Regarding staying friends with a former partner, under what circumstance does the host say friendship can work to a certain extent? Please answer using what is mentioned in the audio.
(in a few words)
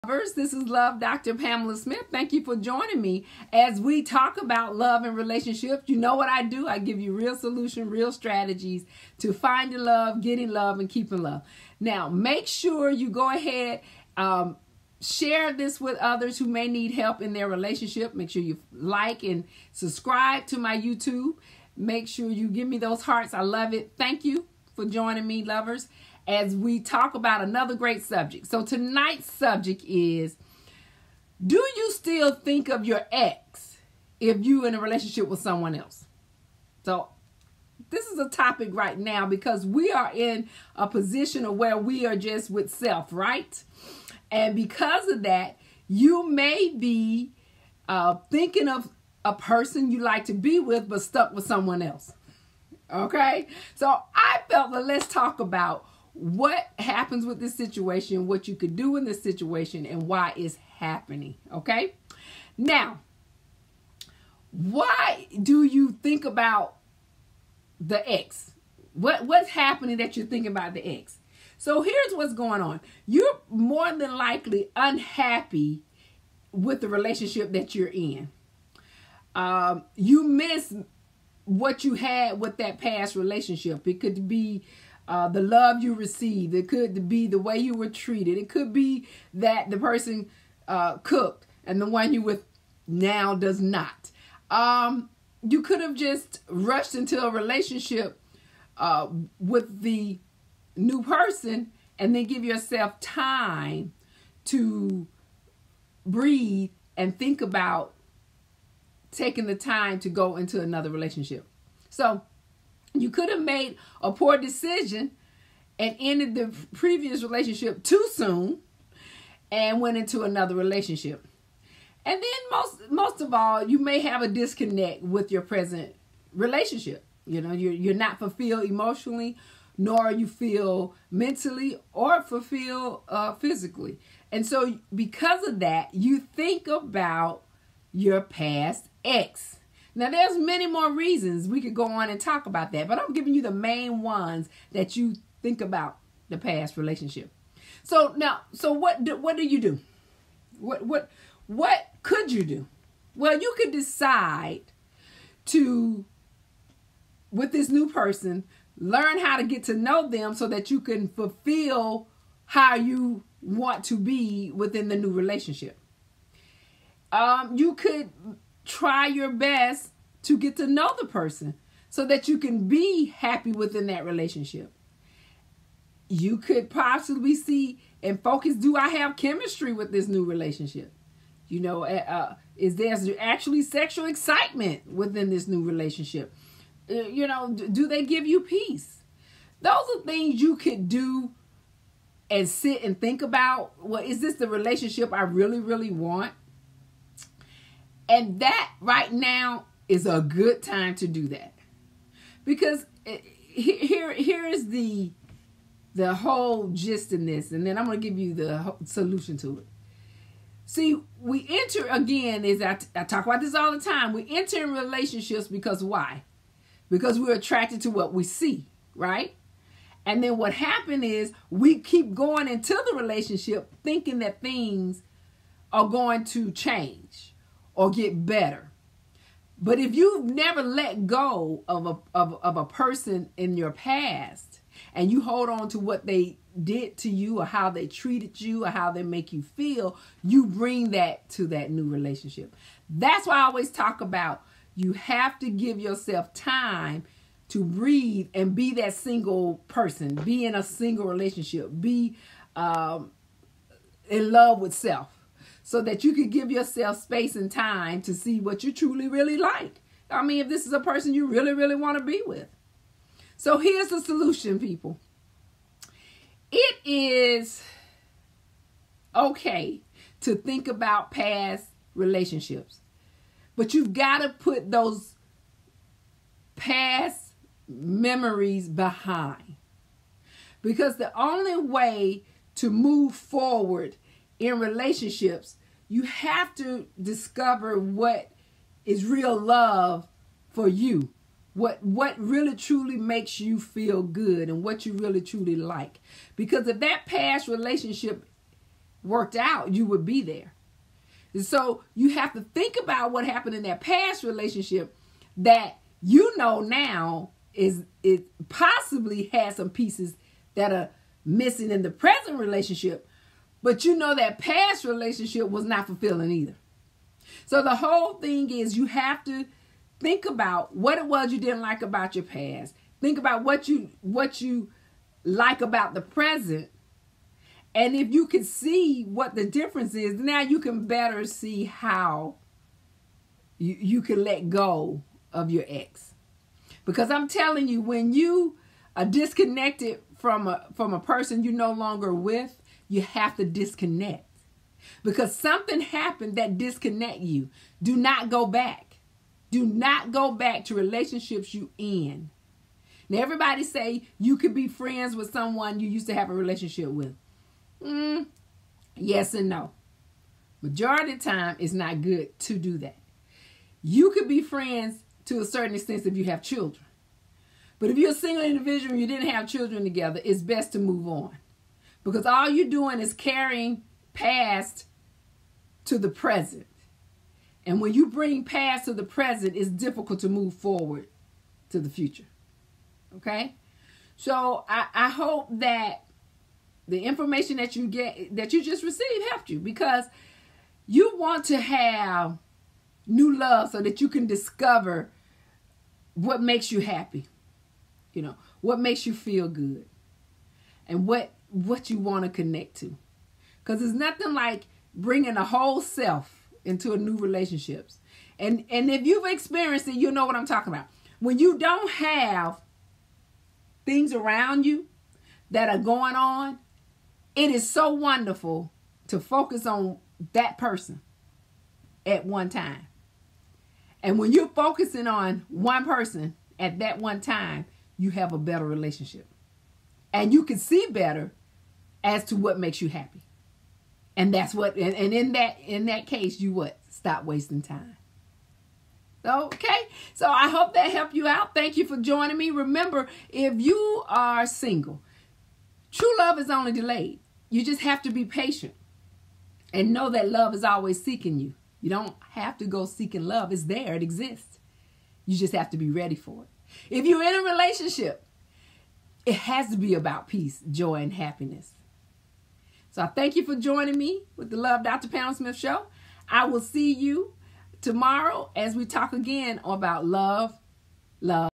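if you have children.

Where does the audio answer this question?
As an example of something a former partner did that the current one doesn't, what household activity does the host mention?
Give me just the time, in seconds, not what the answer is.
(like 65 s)
90 s.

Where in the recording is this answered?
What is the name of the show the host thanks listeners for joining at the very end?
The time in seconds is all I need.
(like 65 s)
464 s.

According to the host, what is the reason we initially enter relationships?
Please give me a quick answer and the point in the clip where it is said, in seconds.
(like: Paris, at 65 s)
attracted to what we see, at 217 s.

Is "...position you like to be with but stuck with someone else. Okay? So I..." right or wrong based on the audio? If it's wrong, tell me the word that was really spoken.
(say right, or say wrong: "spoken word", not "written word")
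wrong: "person", not "position".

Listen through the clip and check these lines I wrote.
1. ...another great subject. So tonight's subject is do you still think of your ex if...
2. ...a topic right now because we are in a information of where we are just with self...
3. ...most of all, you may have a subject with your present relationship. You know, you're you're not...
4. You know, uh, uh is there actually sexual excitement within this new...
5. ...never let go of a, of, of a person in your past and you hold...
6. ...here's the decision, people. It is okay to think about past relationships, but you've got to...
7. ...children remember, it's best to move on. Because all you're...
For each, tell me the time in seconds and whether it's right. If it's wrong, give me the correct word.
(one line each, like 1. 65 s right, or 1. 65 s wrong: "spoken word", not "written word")
1. 27 s right
2. 38 s wrong: "position", not "information"
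3. 122 s wrong: "disconnect", not "subject"
4. 181 s right
5. 230 s right
6. 263 s wrong: "solution", not "decision"
7. 369 s wrong: "together", not "remember".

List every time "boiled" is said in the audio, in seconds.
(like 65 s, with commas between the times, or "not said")
not said.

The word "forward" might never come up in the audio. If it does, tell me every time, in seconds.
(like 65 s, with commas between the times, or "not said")
283 s, 380 s.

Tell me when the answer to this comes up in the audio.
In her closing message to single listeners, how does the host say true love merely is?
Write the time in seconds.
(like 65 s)
446 s.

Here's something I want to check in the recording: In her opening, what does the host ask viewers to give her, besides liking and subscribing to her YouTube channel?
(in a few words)
hearts.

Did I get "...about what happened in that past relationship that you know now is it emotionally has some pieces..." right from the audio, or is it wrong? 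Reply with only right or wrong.
wrong.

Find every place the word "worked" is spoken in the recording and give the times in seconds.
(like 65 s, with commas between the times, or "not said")
299 s.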